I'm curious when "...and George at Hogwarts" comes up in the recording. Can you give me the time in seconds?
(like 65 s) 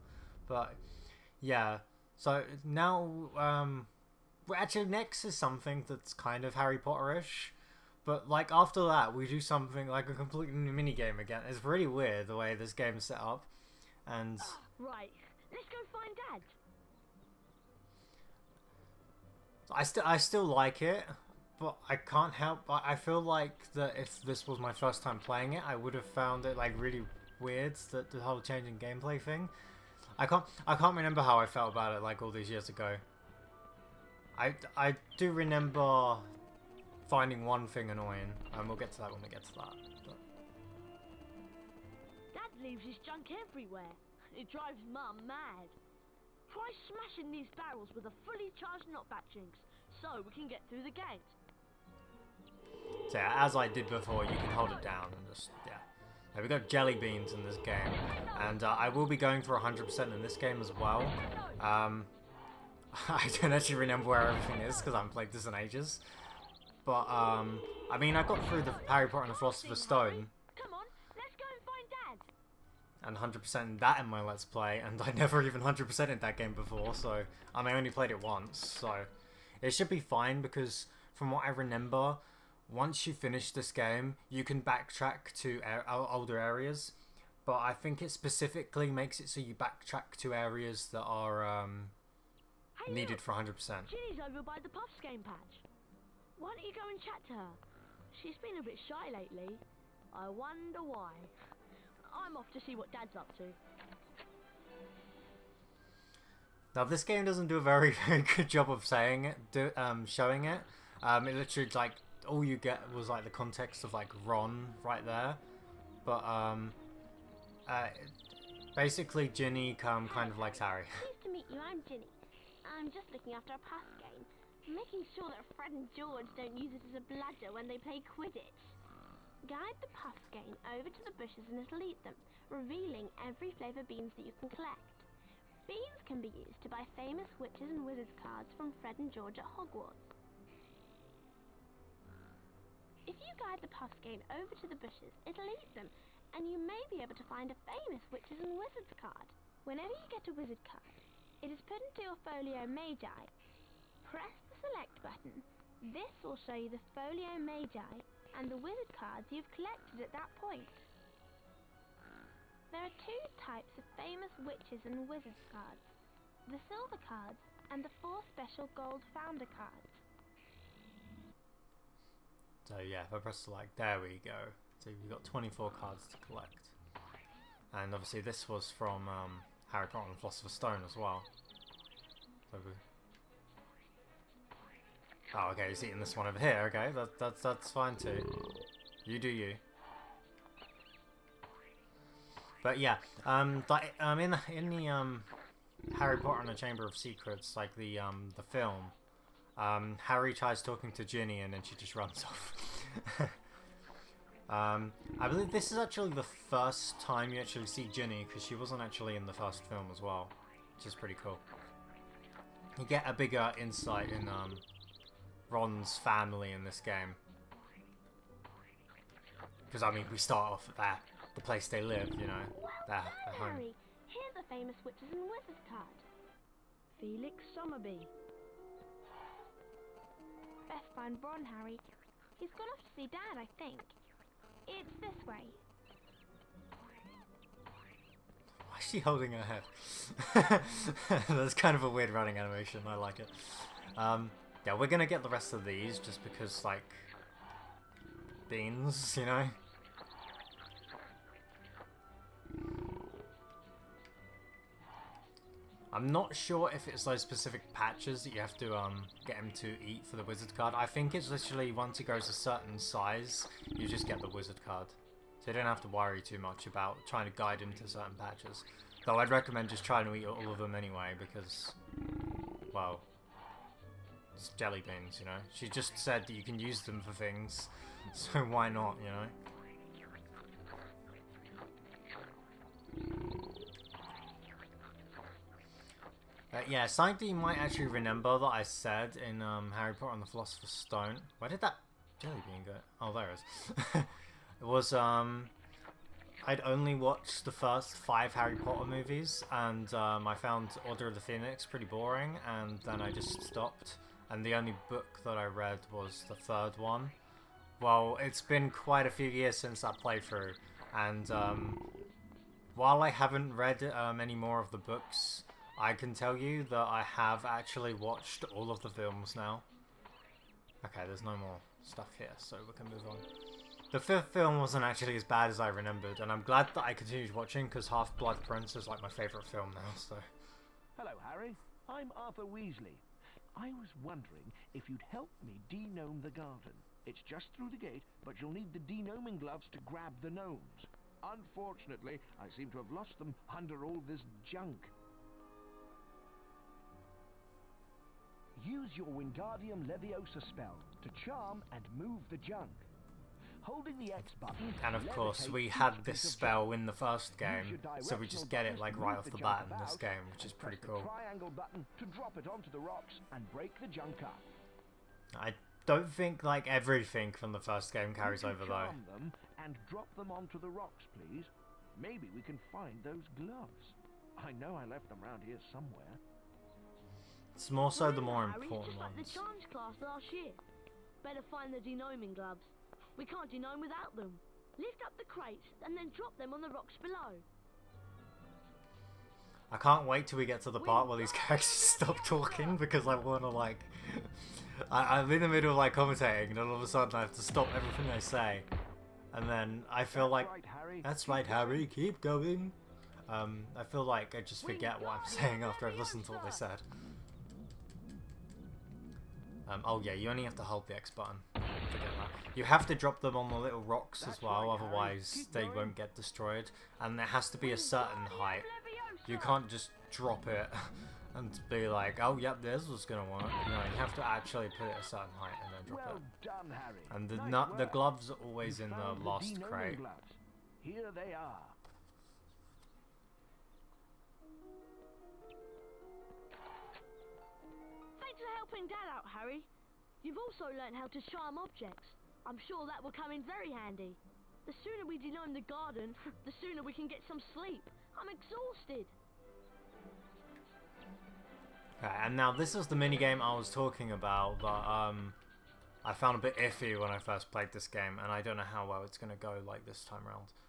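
139 s.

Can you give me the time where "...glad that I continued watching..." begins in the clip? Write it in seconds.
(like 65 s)
326 s.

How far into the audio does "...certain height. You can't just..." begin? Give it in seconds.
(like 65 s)
417 s.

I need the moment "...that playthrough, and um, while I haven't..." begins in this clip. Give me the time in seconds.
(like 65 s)
309 s.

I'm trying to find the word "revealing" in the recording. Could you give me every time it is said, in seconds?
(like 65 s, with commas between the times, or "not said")
132 s.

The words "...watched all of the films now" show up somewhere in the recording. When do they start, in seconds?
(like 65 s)
317 s.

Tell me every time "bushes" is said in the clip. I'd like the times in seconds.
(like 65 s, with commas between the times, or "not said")
131 s, 144 s.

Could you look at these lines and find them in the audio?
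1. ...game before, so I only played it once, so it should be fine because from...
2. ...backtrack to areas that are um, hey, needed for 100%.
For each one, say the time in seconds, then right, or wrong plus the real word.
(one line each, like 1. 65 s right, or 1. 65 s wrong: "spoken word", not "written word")
1. 76 s right
2. 89 s right.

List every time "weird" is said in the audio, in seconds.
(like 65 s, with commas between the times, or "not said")
11 s, 27 s, 241 s.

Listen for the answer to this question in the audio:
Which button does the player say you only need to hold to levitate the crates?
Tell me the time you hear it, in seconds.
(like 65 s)
410 s.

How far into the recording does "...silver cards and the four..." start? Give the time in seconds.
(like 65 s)
166 s.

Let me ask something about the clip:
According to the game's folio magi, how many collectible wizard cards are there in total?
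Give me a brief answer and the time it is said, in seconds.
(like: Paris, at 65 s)
24, at 175 s.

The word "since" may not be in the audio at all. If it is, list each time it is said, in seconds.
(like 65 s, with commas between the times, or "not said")
309 s.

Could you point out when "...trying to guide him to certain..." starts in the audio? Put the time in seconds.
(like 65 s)
267 s.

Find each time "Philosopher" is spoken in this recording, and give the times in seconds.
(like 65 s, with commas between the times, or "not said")
69 s, 180 s, 290 s.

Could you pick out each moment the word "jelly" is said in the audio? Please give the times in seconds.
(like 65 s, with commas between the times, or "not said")
56 s, 274 s, 292 s.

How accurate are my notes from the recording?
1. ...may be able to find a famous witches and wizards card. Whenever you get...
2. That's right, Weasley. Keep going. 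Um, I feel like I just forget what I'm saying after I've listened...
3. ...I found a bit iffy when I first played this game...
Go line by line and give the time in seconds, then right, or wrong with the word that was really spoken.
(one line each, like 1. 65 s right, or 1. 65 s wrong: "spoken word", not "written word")
1. 146 s right
2. 401 s wrong: "Harry", not "Weasley"
3. 456 s right.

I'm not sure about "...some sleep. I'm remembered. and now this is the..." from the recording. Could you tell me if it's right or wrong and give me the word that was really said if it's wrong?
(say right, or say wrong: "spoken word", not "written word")
wrong: "exhausted", not "remembered".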